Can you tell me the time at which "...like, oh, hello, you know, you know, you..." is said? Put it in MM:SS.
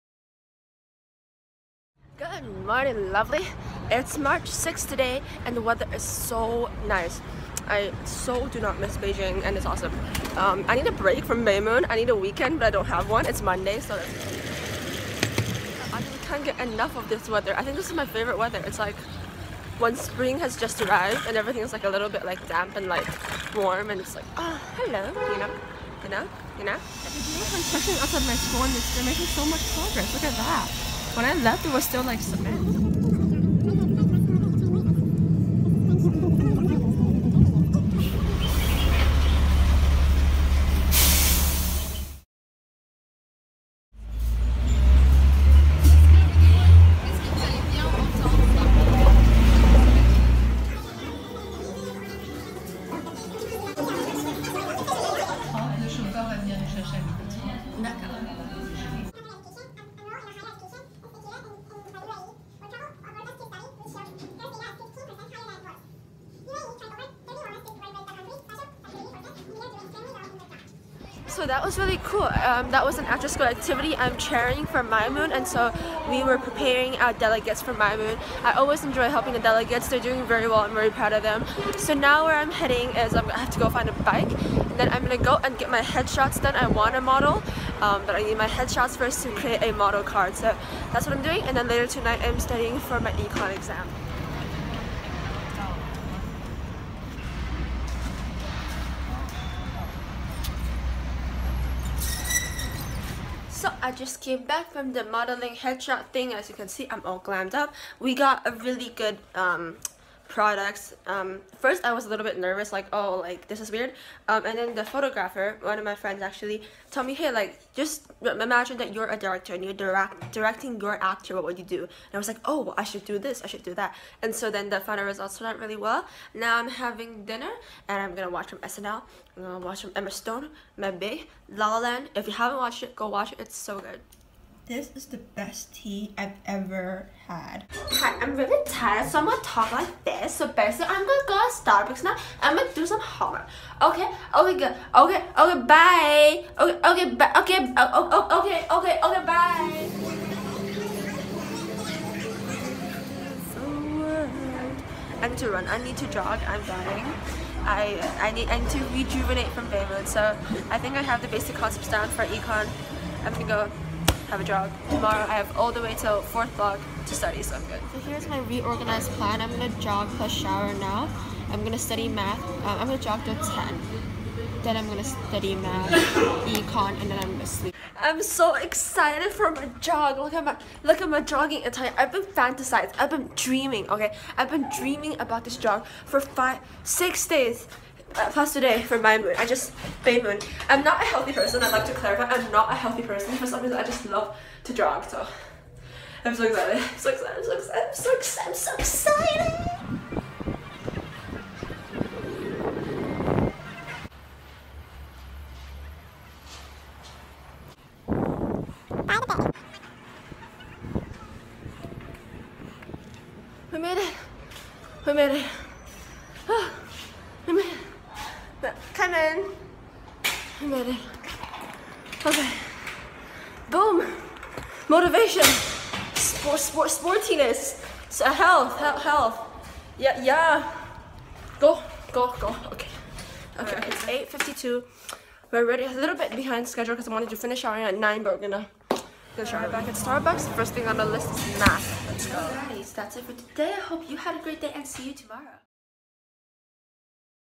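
00:24.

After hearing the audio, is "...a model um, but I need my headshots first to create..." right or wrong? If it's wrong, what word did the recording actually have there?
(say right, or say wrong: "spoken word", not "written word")
right.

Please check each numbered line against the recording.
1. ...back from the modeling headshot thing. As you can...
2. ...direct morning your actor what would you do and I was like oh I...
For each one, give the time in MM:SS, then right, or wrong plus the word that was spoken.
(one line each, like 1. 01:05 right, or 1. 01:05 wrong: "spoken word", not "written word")
1. 01:44 right
2. 01:59 wrong: "directing", not "morning".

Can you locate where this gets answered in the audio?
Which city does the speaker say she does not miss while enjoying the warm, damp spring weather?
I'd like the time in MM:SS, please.
00:08.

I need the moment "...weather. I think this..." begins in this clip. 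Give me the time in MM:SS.
00:17.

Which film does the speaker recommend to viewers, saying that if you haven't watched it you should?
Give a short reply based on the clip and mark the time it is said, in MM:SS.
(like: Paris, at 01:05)
La La Land, at 02:11.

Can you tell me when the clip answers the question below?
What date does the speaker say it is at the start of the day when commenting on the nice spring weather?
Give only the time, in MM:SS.
00:04.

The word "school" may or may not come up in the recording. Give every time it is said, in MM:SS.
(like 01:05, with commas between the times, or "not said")
00:28, 01:13.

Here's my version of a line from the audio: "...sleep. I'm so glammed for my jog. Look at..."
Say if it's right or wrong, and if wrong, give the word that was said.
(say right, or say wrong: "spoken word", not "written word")
wrong: "excited", not "glammed".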